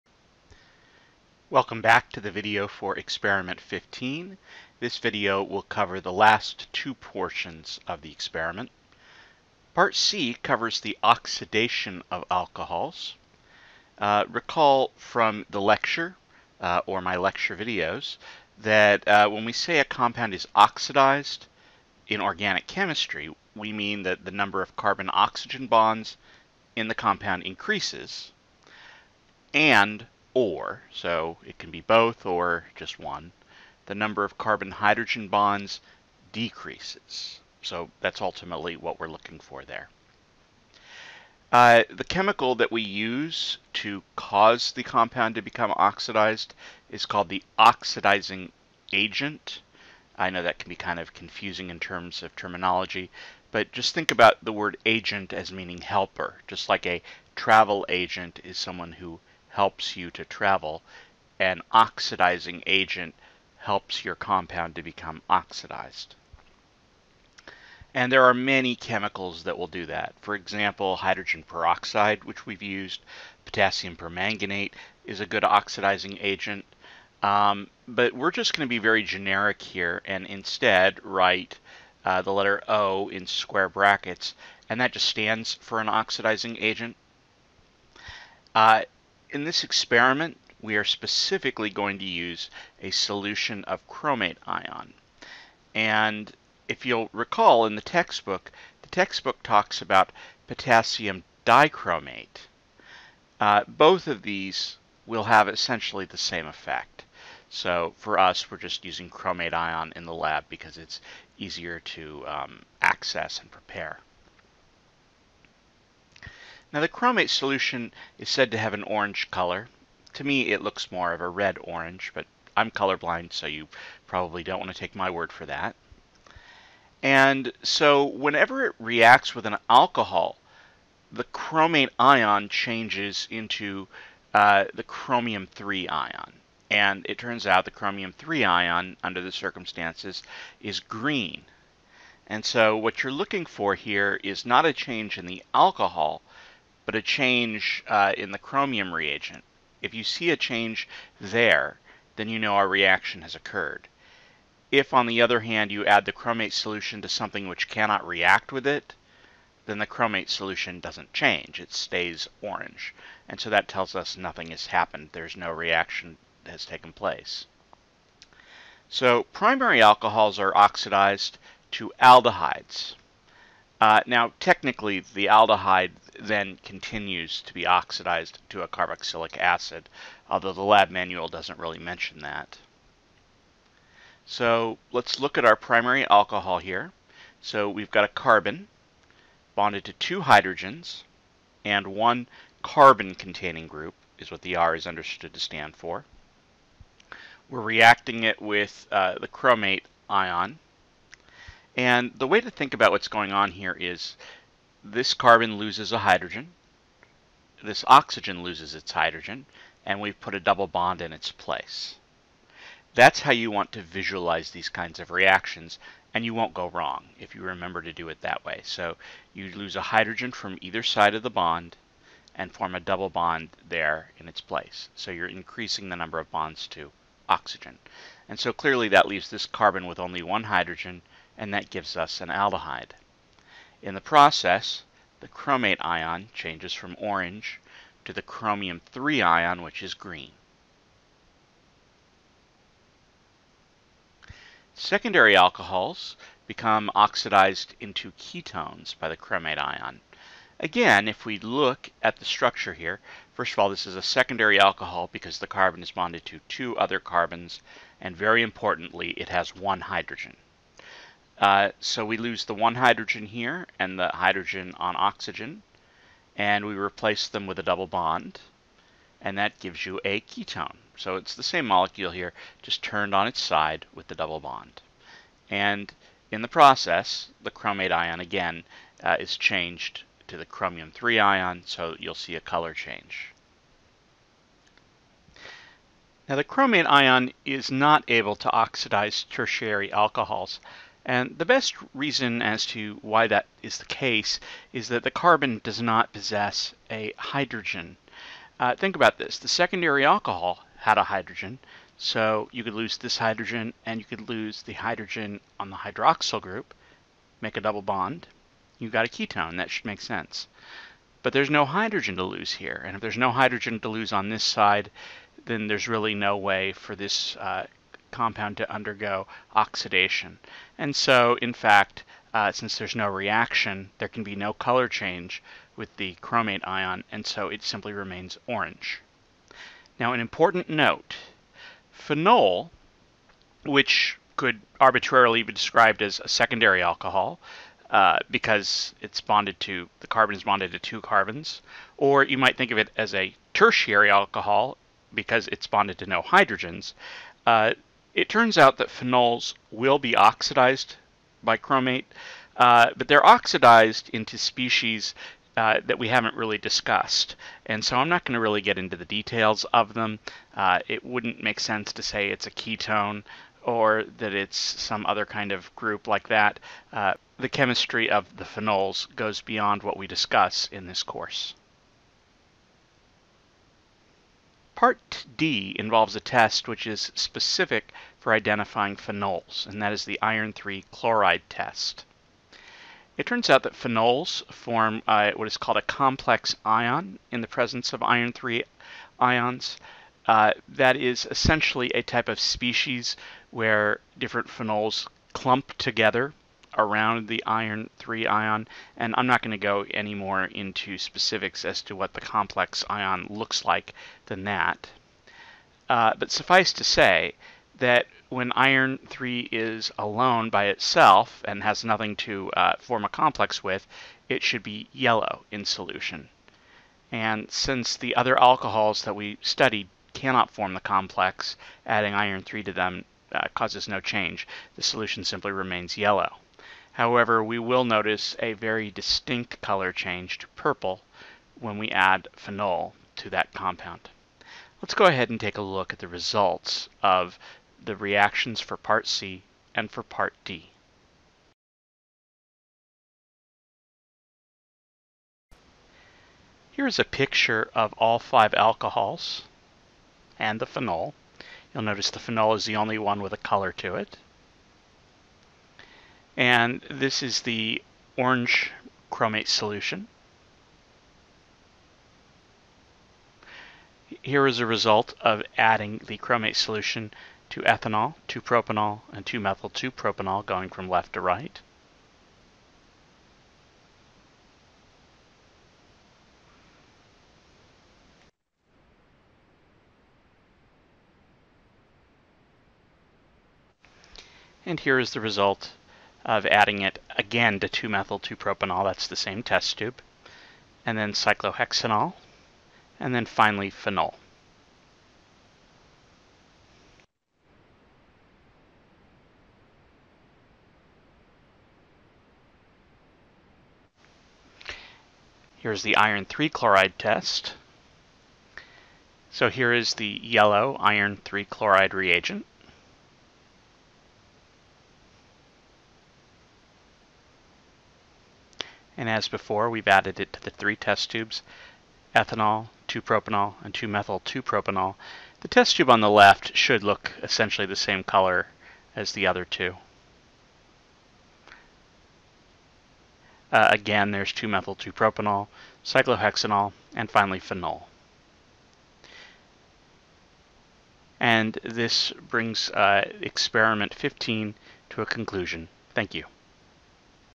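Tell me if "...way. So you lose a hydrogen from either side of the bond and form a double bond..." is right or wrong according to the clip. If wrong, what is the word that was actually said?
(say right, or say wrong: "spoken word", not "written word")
right.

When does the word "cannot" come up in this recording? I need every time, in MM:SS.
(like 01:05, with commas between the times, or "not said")
02:37, 07:00.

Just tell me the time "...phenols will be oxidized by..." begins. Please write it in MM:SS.
05:48.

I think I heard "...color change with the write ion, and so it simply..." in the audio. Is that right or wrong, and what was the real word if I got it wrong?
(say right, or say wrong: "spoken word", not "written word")
wrong: "chromate", not "write".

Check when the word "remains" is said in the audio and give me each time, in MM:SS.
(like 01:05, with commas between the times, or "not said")
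05:27, 07:05.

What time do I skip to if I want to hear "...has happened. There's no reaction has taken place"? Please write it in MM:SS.
02:44.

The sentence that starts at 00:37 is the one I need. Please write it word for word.
So that's ultimately what we're looking for there.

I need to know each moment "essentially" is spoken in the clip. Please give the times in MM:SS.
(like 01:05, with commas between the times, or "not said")
01:45, 06:31, 08:47.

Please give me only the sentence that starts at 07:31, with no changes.
You'll notice the phenol is the only one with a color to it.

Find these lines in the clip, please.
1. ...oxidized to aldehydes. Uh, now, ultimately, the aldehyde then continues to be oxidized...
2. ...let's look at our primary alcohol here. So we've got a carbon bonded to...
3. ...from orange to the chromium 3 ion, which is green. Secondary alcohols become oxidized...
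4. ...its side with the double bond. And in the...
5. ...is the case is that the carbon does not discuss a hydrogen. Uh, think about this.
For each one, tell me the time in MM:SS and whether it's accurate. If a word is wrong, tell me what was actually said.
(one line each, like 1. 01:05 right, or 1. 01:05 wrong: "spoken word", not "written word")
1. 02:50 wrong: "technically", not "ultimately"
2. 03:04 right
3. 03:56 right
4. 04:33 right
5. 04:53 wrong: "possess", not "discuss".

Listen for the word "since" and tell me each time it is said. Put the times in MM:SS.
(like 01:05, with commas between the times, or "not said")
05:22, 06:57.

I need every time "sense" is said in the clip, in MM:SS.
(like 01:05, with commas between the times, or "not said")
05:10, 06:01.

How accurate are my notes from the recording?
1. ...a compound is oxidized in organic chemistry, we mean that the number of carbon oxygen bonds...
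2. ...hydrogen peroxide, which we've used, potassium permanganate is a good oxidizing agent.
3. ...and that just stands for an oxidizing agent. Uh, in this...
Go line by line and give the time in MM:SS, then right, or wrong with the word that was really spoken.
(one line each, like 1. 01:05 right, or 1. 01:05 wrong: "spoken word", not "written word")
1. 00:19 right
2. 01:10 right
3. 01:24 right.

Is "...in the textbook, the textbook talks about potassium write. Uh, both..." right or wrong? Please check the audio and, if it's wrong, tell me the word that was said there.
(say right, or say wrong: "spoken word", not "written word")
wrong: "dichromate", not "write".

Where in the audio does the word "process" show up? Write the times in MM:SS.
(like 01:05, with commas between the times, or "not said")
03:54, 04:36.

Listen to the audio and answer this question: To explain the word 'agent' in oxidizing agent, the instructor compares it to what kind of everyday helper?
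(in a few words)
travel agent.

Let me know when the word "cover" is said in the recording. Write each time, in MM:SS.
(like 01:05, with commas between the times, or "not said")
00:05, 00:10.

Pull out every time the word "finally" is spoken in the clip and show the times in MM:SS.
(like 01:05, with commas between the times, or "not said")
08:13, 08:57.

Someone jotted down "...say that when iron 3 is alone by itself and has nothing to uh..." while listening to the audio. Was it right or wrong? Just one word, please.
right.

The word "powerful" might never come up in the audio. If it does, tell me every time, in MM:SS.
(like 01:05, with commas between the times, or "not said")
not said.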